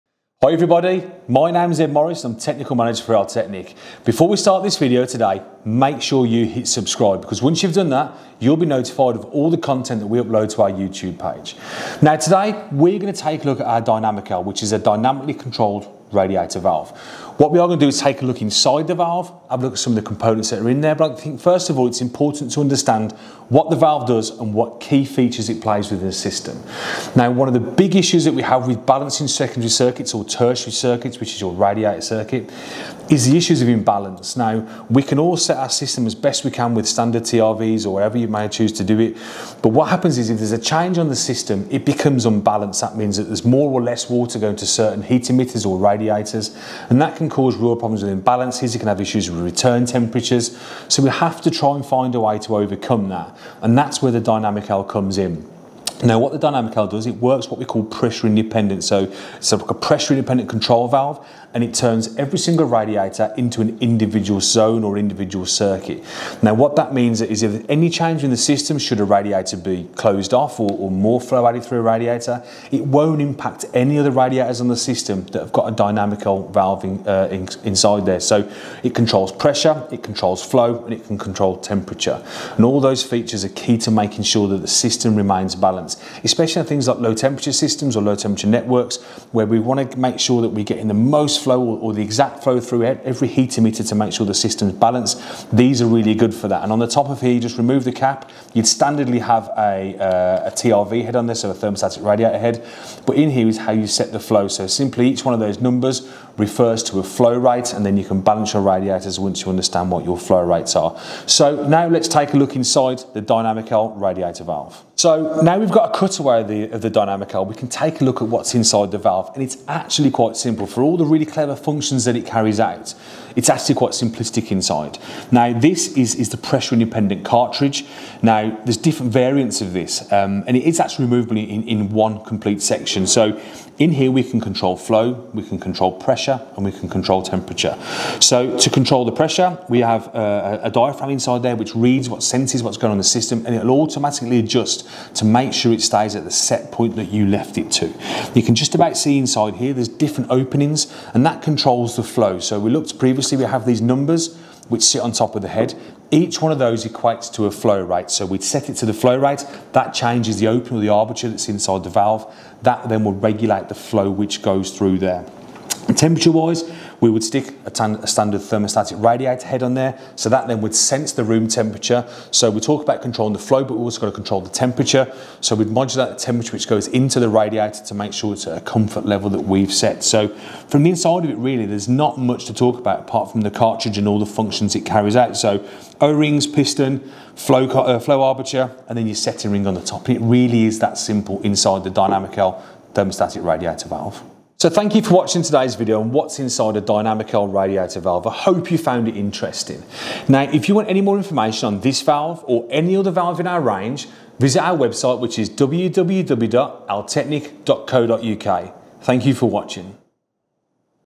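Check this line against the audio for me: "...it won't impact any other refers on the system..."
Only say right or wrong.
wrong.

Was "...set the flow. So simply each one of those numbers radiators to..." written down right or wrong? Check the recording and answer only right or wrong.
wrong.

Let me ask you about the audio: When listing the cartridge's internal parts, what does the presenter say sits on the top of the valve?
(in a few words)
Setting ring.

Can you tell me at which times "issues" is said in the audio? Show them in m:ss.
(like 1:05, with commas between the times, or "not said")
0:27, 0:33, 0:48.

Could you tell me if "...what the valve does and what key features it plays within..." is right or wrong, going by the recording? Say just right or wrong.
right.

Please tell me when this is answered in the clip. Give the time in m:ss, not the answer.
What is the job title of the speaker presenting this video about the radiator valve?
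0:02.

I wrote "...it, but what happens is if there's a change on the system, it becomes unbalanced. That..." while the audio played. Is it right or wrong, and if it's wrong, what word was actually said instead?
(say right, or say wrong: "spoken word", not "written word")
right.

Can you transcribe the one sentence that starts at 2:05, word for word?
Now, this is, is the pressure independent cartridge.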